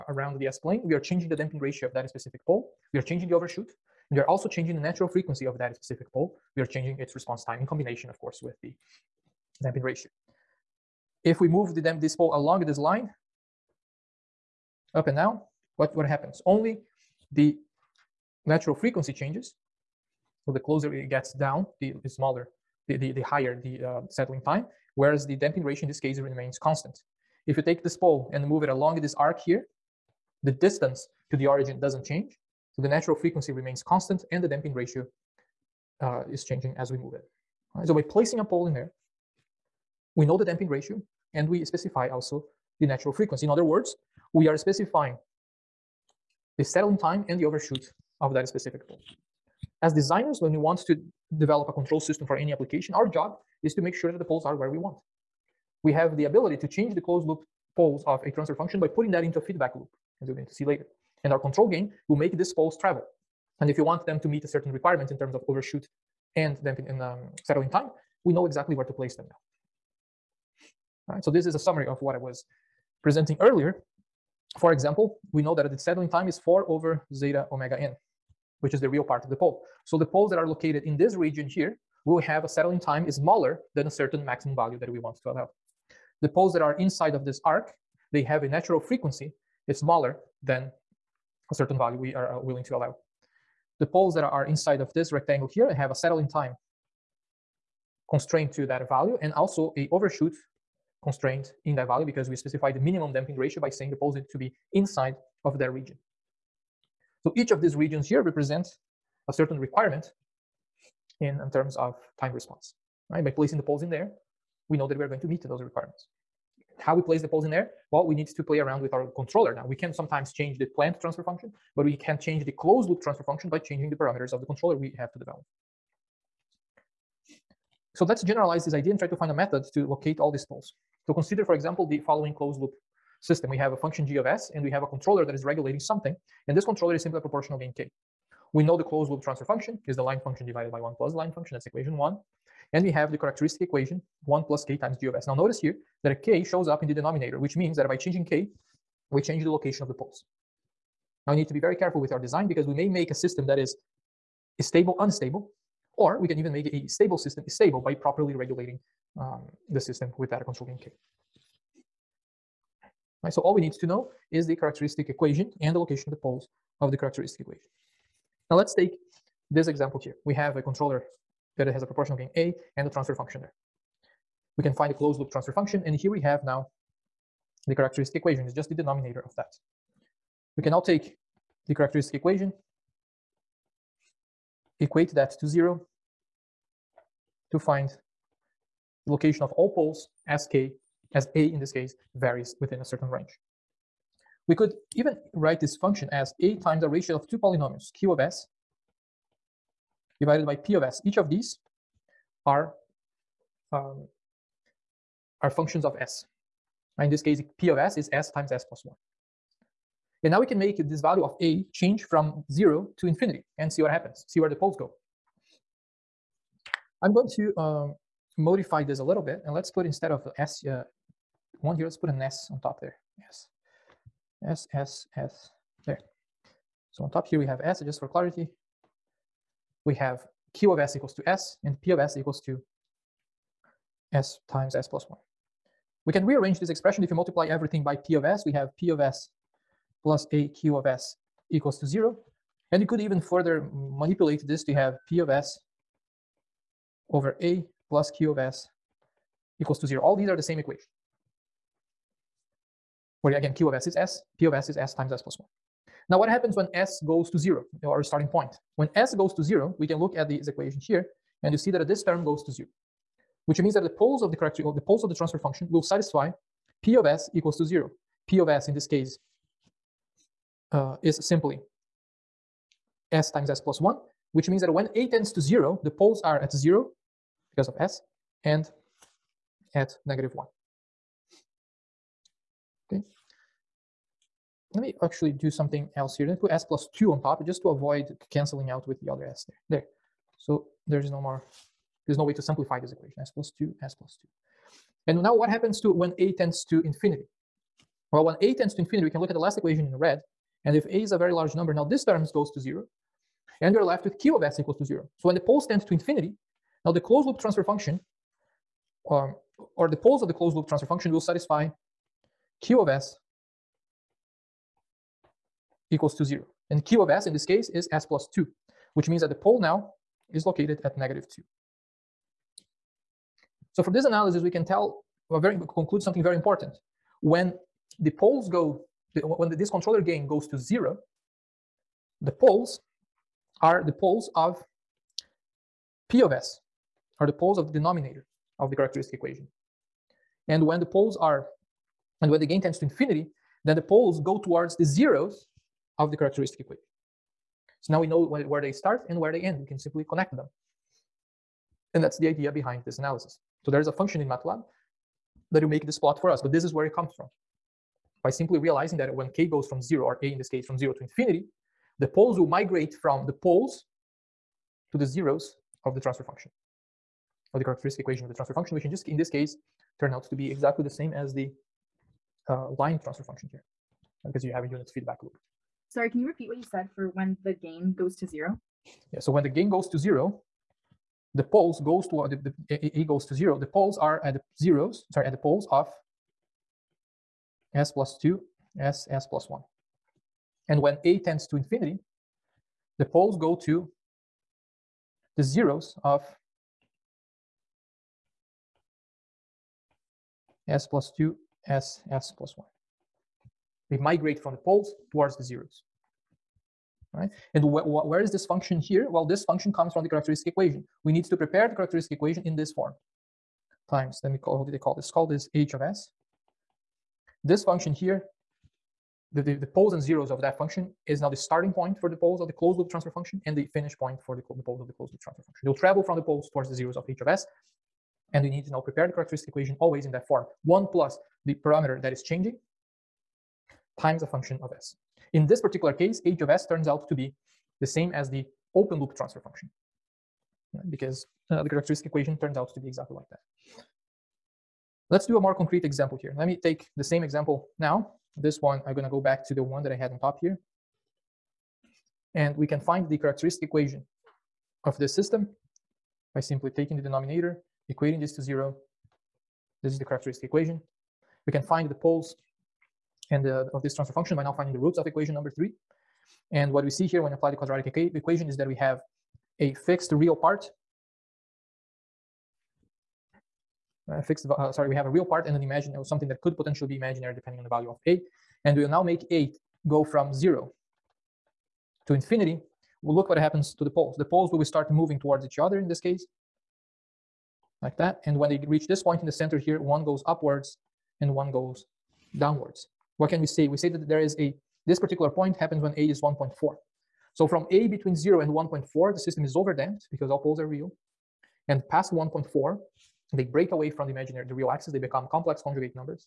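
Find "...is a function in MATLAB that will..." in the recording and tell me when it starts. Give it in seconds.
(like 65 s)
353 s.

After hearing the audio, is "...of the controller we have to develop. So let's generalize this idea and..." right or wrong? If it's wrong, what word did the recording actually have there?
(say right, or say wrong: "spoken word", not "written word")
right.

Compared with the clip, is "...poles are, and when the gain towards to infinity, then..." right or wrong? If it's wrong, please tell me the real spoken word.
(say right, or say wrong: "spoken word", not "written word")
wrong: "tends", not "towards".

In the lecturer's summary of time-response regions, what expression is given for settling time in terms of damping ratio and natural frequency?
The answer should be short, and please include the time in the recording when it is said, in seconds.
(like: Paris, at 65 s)
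4 over zeta omega n, at 76 s.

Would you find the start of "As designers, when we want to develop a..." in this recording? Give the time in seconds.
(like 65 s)
49 s.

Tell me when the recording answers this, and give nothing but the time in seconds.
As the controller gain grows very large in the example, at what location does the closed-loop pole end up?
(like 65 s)
320 s.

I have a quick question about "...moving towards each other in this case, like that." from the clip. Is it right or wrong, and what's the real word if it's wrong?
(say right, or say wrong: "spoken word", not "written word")
right.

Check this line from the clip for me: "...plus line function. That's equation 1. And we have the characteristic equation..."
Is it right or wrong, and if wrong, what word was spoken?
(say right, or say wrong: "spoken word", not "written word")
right.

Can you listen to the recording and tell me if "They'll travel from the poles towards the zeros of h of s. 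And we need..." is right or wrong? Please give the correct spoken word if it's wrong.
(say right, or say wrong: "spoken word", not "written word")
right.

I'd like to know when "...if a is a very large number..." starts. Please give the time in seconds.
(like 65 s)
300 s.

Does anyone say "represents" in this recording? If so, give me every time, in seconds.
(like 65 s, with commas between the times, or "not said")
108 s.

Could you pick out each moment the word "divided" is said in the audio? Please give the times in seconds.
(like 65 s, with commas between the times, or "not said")
140 s, 200 s.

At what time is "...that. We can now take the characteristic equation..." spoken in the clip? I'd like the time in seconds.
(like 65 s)
179 s.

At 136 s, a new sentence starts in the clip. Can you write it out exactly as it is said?
And this controller is simply a proportional gain k.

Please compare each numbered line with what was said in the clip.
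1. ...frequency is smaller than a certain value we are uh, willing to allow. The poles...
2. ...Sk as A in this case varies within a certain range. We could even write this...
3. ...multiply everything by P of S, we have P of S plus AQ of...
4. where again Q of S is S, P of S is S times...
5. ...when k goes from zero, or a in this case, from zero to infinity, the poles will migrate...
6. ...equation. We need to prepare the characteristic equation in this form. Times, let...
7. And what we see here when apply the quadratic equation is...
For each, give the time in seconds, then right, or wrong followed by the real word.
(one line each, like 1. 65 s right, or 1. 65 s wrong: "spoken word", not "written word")
1. 88 s right
2. 190 s right
3. 237 s right
4. 253 s right
5. 359 s right
6. 410 s right
7. 466 s right.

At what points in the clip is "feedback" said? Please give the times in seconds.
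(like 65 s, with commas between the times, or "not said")
59 s, 374 s.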